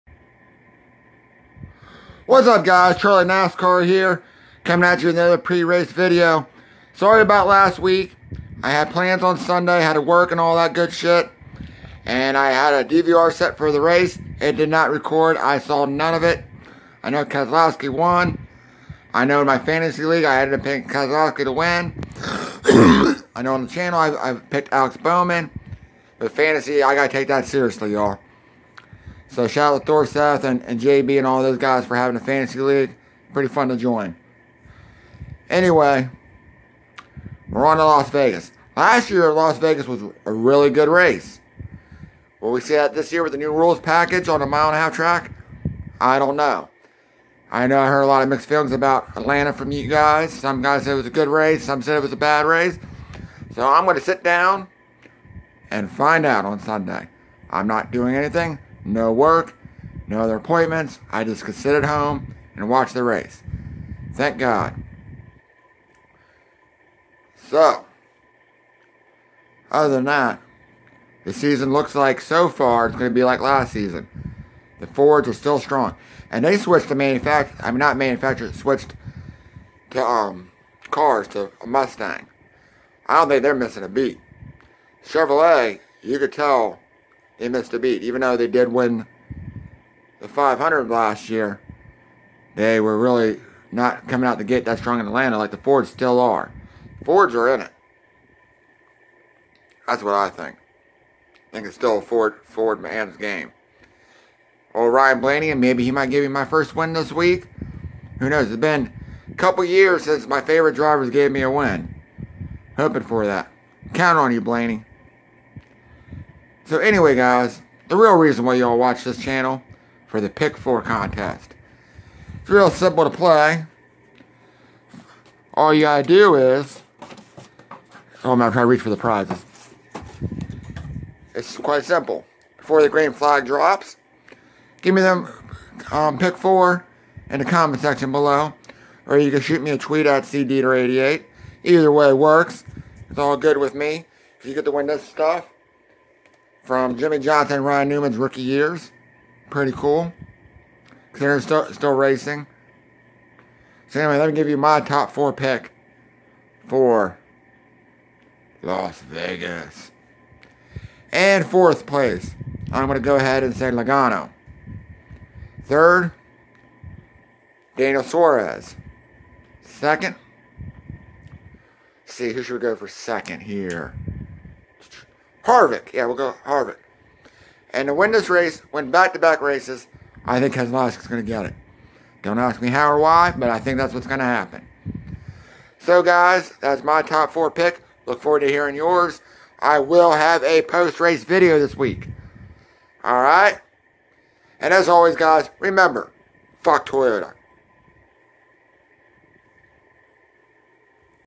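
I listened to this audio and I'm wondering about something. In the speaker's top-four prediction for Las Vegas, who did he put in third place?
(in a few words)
Daniel Suarez.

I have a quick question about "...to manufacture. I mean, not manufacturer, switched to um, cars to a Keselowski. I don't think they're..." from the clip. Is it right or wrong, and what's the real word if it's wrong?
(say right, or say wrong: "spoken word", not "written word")
wrong: "Mustang", not "Keselowski".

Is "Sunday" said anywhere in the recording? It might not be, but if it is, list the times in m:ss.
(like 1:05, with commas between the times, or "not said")
0:09, 0:56.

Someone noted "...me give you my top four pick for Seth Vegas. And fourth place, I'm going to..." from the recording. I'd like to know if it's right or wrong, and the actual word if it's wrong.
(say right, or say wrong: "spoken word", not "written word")
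wrong: "Las", not "Seth".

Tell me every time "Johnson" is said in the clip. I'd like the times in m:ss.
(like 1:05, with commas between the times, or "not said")
2:27.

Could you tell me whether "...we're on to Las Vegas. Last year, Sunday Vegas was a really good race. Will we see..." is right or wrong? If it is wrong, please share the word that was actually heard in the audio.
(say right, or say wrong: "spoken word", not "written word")
wrong: "Las", not "Sunday".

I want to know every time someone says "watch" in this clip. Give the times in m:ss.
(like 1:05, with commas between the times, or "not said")
1:02, 1:58.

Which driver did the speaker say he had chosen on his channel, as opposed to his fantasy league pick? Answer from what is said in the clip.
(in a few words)
Alex Bowman.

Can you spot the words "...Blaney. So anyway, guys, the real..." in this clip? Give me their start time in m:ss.
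1:54.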